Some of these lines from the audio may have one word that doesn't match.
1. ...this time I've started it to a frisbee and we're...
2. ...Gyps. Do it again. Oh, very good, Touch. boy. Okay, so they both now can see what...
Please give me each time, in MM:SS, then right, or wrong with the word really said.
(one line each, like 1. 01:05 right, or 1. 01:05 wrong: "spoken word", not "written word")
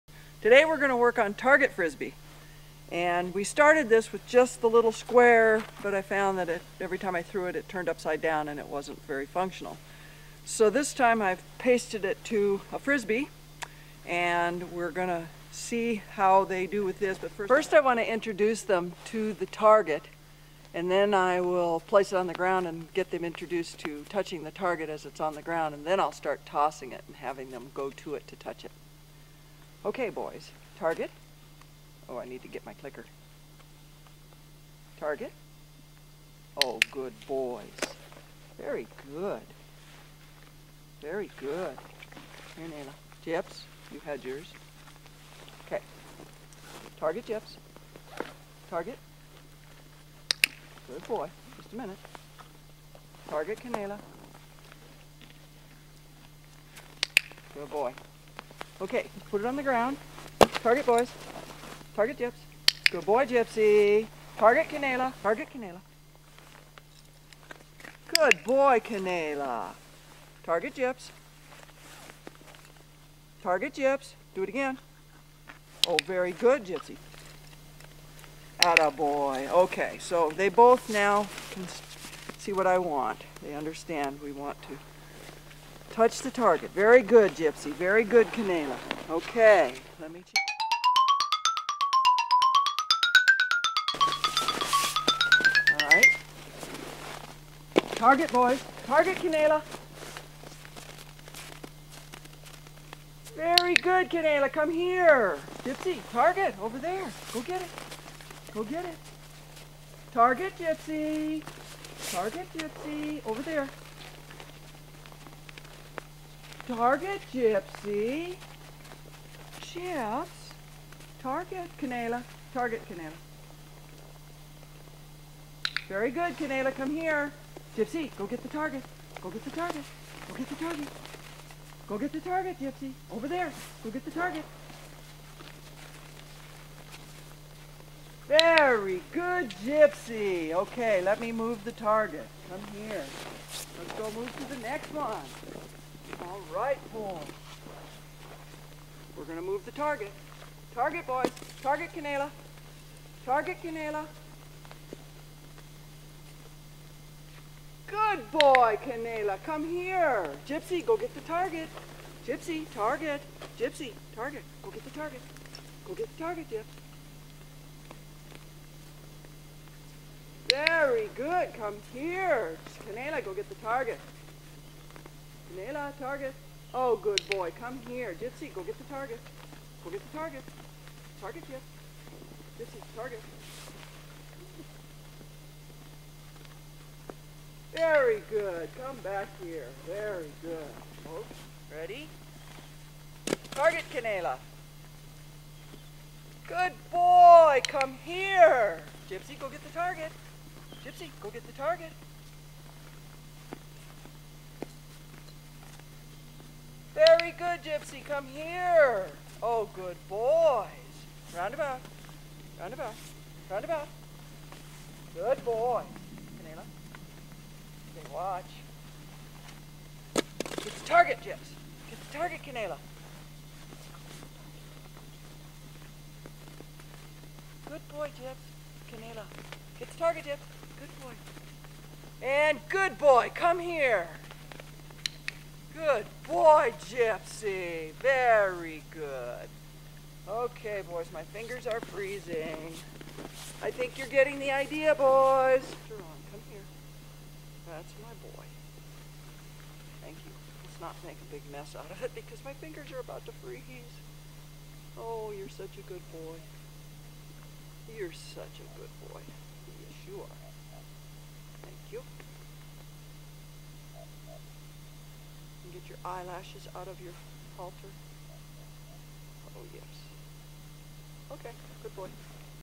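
1. 00:10 wrong: "pasted", not "started"
2. 01:13 wrong: "Gypsy", not "Touch".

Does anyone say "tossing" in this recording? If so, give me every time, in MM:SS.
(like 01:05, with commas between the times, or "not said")
00:26.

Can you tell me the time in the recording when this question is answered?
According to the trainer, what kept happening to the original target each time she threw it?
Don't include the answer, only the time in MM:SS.
00:07.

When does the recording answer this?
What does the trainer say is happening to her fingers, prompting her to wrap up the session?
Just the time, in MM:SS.
04:01.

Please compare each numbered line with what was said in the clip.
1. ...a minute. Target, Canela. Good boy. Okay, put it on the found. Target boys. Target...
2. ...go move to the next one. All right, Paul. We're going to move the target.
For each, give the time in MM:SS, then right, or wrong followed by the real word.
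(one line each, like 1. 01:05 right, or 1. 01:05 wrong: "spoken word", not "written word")
1. 00:51 wrong: "ground", not "found"
2. 02:23 right.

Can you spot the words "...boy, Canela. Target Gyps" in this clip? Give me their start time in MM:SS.
01:08.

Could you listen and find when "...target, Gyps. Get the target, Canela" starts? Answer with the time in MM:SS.
03:40.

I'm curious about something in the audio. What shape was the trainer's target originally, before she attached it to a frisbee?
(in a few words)
little square.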